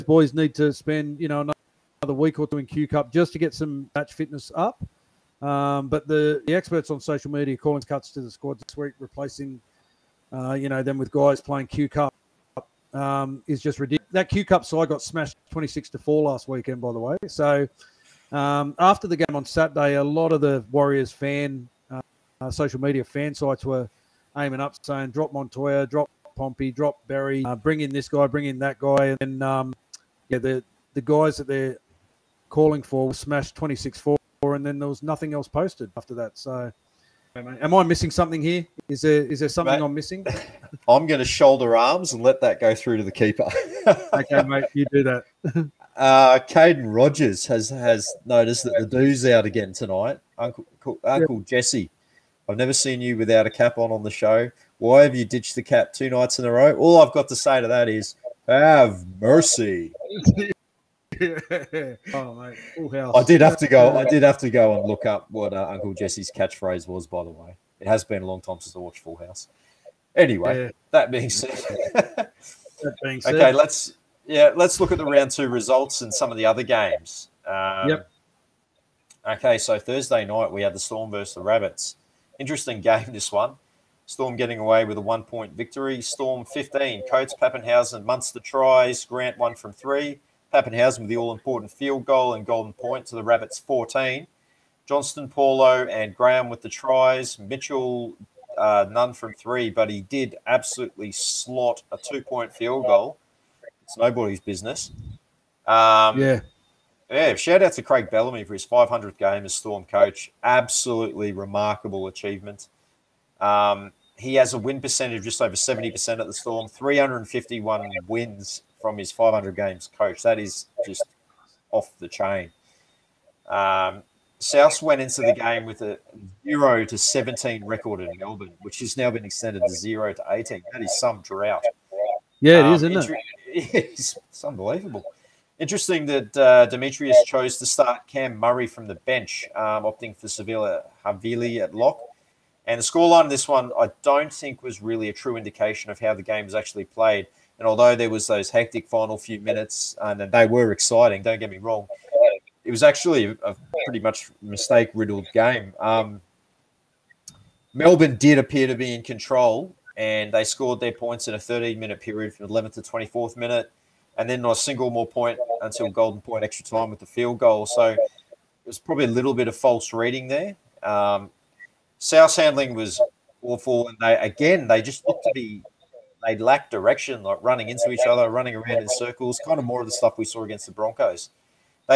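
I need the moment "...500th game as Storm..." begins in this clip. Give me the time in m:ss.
1:48.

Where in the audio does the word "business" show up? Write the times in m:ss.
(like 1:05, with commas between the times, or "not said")
1:44.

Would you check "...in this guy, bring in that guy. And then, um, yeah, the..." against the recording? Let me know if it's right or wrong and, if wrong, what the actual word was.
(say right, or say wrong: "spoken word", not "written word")
right.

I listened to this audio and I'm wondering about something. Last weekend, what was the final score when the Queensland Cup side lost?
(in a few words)
26 to 4.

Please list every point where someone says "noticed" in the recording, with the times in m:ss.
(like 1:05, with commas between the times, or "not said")
0:48.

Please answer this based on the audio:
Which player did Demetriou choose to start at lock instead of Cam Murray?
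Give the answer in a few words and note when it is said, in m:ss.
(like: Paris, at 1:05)
Siliva Havili, at 2:20.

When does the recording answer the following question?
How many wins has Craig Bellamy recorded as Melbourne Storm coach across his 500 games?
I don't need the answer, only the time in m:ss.
1:56.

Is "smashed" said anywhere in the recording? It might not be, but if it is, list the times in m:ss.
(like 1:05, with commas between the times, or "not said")
0:15, 0:33.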